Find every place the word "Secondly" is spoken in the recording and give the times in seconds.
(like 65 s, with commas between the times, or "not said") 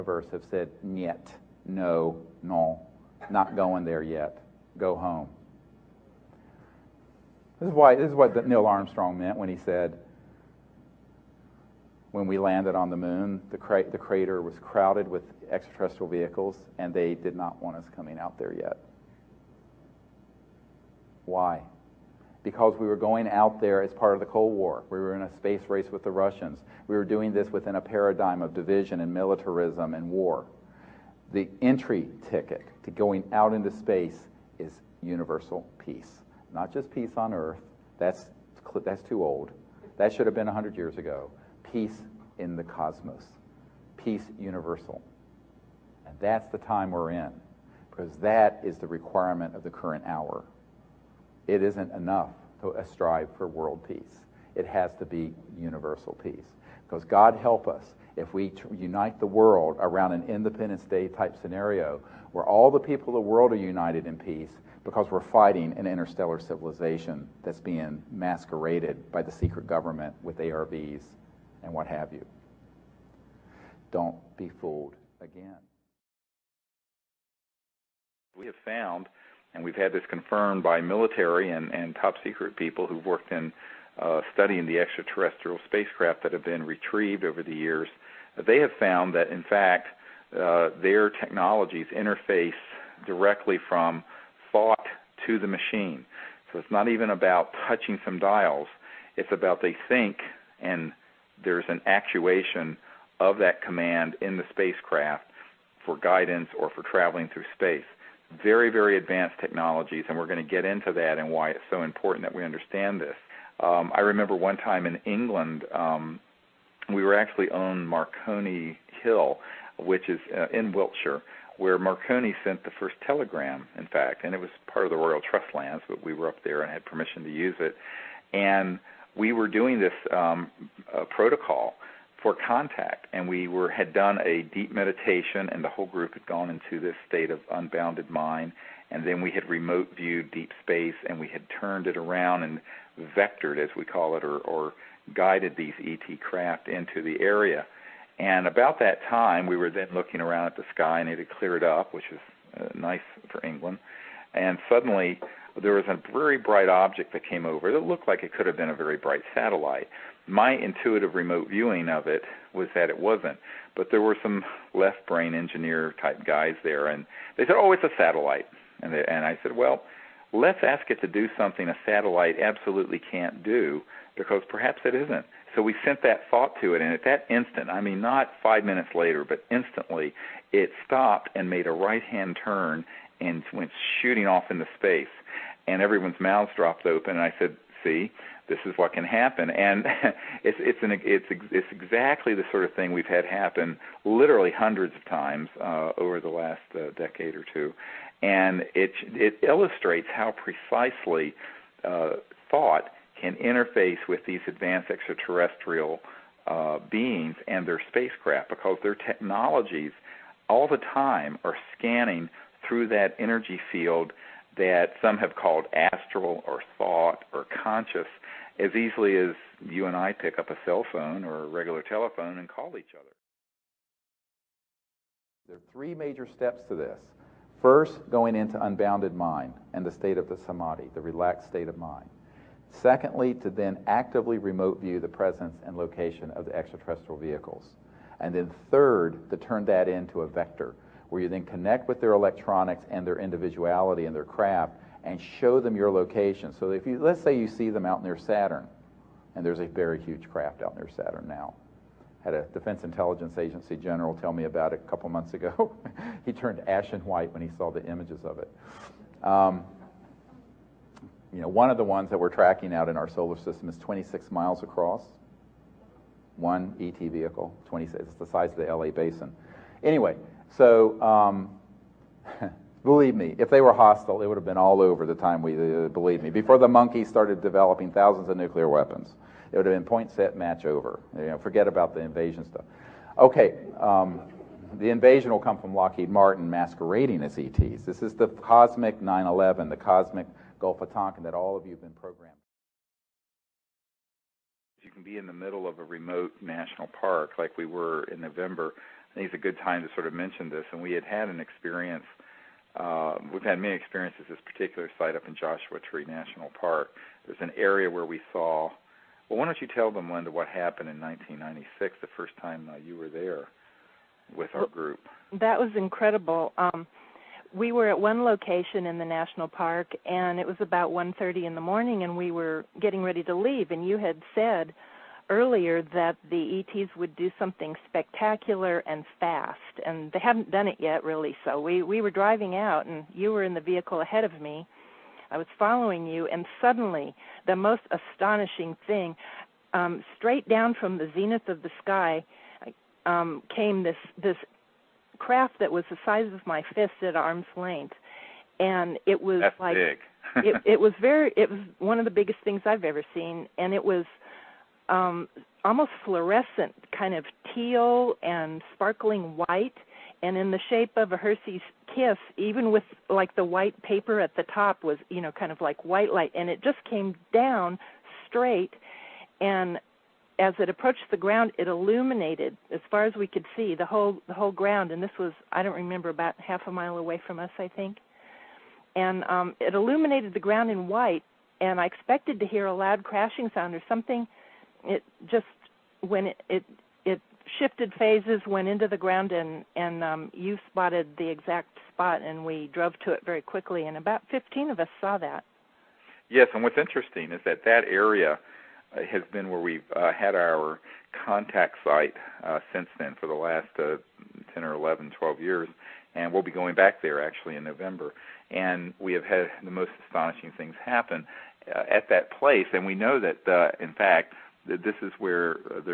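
232 s.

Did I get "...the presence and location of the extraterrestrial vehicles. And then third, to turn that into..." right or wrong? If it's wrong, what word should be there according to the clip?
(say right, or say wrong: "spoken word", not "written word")
right.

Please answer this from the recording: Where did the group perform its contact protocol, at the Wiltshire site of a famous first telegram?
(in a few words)
Marconi Hill.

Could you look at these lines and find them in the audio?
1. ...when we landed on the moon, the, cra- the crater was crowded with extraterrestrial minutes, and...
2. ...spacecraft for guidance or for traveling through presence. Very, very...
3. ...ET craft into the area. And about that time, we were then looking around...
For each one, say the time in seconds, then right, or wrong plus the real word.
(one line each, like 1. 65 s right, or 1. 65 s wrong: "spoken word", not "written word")
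1. 12 s wrong: "vehicles", not "minutes"
2. 104 s wrong: "space", not "presence"
3. 145 s right.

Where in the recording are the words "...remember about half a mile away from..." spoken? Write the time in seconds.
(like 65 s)
375 s.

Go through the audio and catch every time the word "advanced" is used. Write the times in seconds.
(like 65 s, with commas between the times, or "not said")
108 s, 204 s.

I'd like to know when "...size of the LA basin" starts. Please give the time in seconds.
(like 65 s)
268 s.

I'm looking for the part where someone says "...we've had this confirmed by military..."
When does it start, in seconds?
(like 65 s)
79 s.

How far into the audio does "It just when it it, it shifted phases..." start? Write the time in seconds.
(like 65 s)
384 s.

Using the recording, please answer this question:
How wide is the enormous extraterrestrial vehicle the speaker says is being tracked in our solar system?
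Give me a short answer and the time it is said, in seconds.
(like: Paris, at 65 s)
26 miles, at 263 s.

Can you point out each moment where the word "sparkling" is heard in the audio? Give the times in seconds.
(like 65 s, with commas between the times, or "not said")
358 s.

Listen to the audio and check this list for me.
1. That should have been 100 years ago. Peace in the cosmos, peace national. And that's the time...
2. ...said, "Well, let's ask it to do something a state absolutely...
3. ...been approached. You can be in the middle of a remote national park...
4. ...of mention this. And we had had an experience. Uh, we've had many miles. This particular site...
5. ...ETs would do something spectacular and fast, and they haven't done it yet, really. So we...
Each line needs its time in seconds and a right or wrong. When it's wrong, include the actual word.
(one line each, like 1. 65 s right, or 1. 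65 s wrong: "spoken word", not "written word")
1. 39 s wrong: "universal", not "national"
2. 169 s wrong: "satellite", not "state"
3. 291 s wrong: "programmed", not "approached"
4. 300 s wrong: "experiences", not "miles"
5. 326 s right.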